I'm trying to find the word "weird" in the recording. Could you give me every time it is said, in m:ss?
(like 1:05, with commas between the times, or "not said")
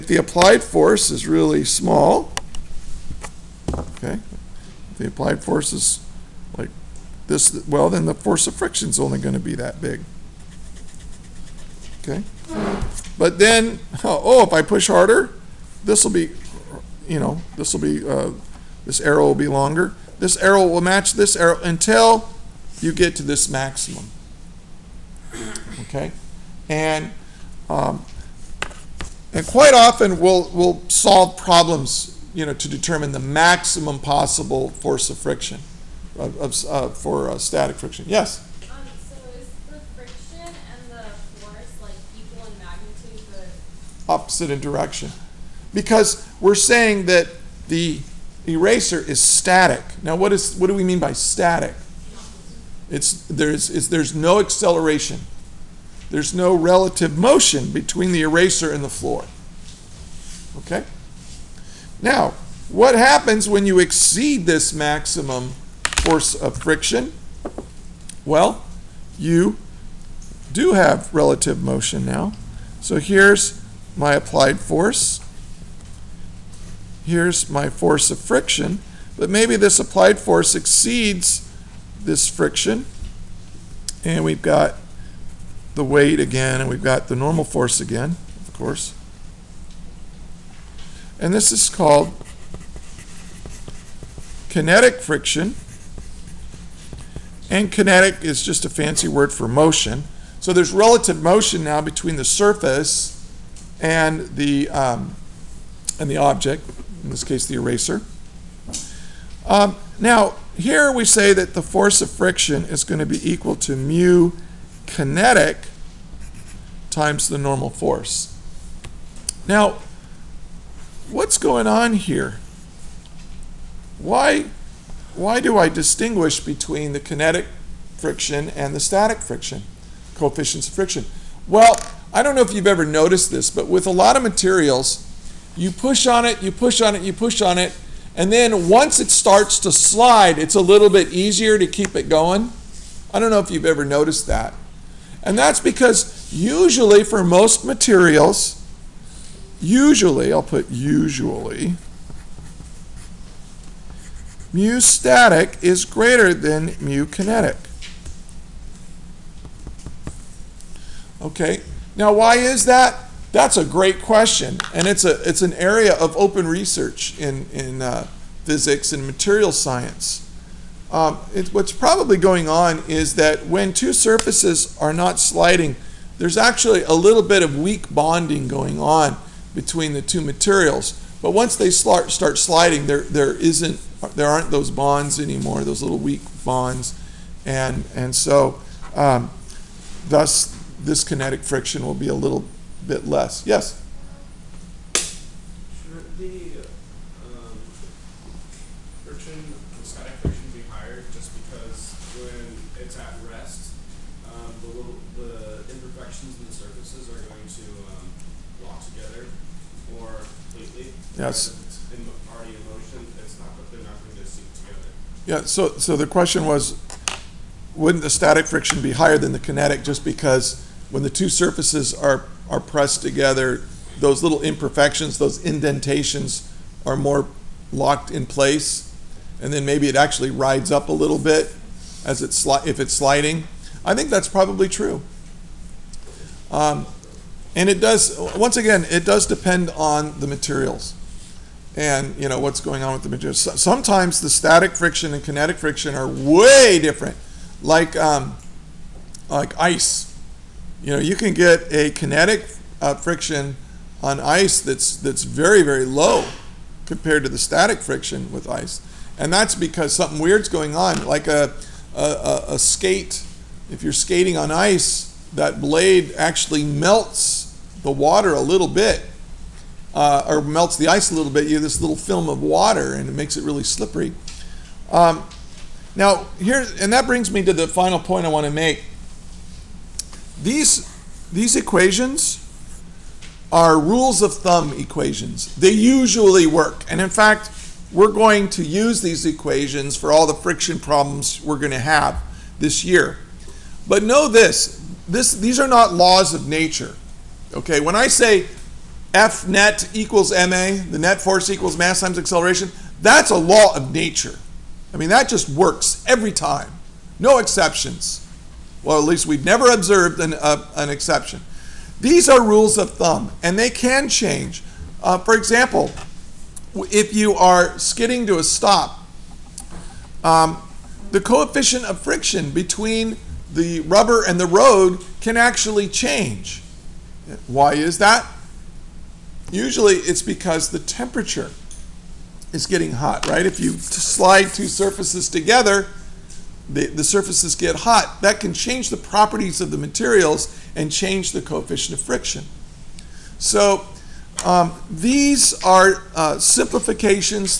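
4:20.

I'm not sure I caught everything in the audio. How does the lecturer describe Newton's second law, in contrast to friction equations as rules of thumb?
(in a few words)
a law of nature.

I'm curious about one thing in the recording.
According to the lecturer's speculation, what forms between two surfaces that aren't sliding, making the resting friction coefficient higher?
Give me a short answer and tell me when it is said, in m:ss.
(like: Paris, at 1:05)
weak bonding, at 2:57.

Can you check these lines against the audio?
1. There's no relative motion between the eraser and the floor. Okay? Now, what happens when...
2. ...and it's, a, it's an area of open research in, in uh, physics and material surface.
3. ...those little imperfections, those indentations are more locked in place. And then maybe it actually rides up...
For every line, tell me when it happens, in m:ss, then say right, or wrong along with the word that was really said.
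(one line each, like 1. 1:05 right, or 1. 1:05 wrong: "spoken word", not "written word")
1. 0:56 right
2. 2:44 wrong: "science", not "surface"
3. 3:43 right.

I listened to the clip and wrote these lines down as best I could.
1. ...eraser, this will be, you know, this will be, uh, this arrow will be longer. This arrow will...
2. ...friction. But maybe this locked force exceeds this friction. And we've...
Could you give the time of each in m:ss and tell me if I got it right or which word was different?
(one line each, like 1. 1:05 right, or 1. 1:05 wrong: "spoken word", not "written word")
1. 0:14 wrong: "harder", not "eraser"
2. 1:18 wrong: "applied", not "locked".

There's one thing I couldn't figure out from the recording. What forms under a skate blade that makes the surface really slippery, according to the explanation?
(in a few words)
film of water.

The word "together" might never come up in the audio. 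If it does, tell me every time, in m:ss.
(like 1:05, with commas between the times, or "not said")
3:43, 5:35.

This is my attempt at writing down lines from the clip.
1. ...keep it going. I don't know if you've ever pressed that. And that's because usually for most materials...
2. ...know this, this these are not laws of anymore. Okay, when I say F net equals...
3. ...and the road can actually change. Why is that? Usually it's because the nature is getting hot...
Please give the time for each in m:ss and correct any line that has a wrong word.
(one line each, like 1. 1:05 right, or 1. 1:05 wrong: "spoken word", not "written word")
1. 2:21 wrong: "noticed", not "pressed"
2. 4:54 wrong: "nature", not "anymore"
3. 5:24 wrong: "temperature", not "nature".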